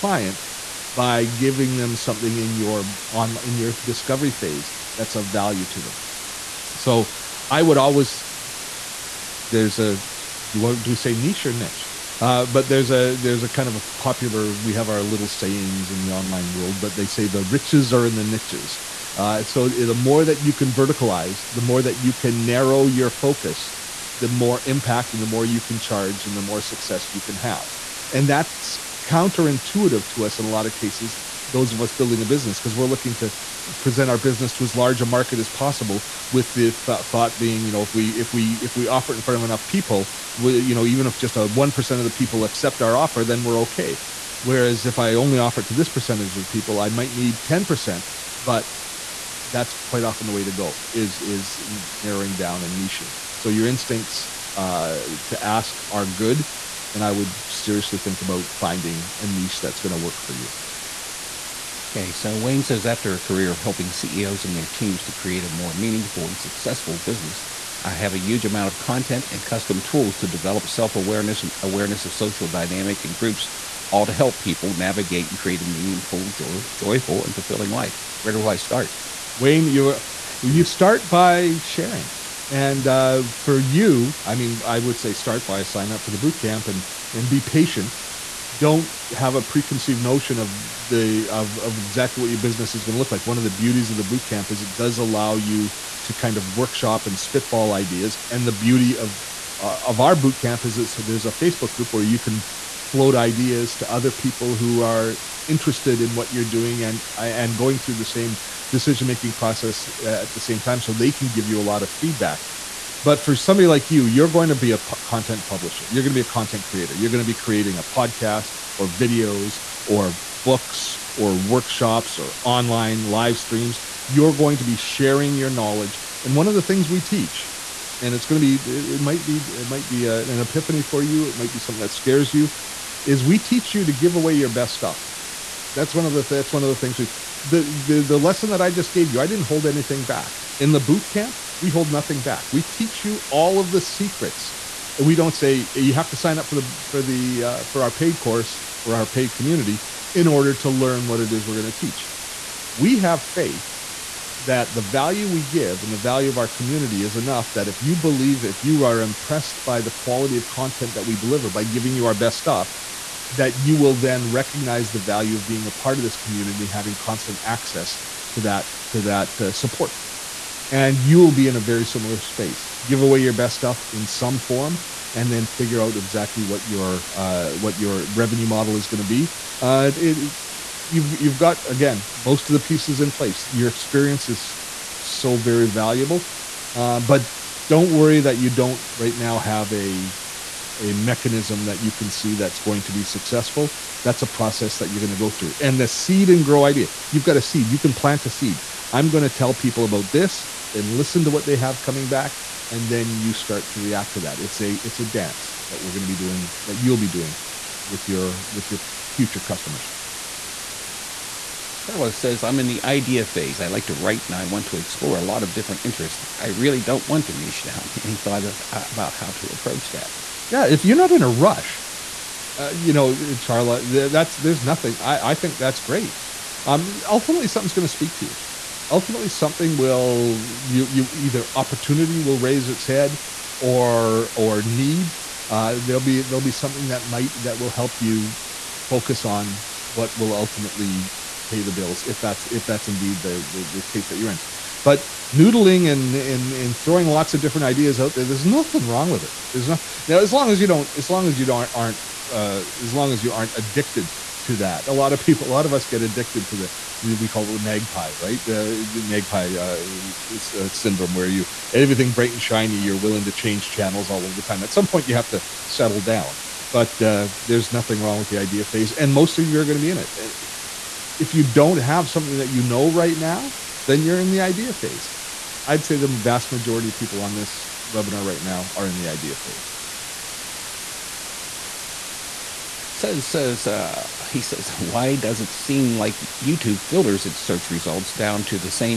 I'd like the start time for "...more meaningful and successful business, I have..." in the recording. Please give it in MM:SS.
01:05.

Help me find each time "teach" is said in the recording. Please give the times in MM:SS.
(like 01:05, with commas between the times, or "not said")
02:07, 02:13, 02:22, 02:31.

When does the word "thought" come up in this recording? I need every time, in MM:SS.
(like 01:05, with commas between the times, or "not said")
00:37, 03:38.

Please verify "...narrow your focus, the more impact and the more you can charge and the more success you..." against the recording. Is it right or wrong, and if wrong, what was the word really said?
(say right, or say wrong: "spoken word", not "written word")
right.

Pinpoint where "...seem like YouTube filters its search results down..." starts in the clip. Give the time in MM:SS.
04:45.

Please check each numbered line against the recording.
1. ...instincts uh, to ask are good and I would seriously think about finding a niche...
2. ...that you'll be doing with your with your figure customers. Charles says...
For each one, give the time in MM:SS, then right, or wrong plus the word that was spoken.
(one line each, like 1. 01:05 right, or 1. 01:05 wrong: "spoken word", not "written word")
1. 00:53 right
2. 03:26 wrong: "future", not "figure".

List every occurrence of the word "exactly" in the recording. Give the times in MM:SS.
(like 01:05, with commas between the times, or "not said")
01:31, 02:55.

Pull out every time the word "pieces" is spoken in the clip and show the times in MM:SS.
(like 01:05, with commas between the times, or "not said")
03:02.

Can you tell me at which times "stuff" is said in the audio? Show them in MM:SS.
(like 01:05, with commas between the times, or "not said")
02:14, 02:42, 02:53.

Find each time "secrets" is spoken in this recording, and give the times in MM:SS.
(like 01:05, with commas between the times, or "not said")
02:23.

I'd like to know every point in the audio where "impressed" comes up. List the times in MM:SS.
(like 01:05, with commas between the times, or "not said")
02:39.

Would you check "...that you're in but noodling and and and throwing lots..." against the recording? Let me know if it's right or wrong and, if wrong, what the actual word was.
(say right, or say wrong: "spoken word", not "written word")
right.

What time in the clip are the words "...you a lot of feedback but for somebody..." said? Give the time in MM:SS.
01:51.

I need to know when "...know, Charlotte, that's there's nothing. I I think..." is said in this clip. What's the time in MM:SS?
03:42.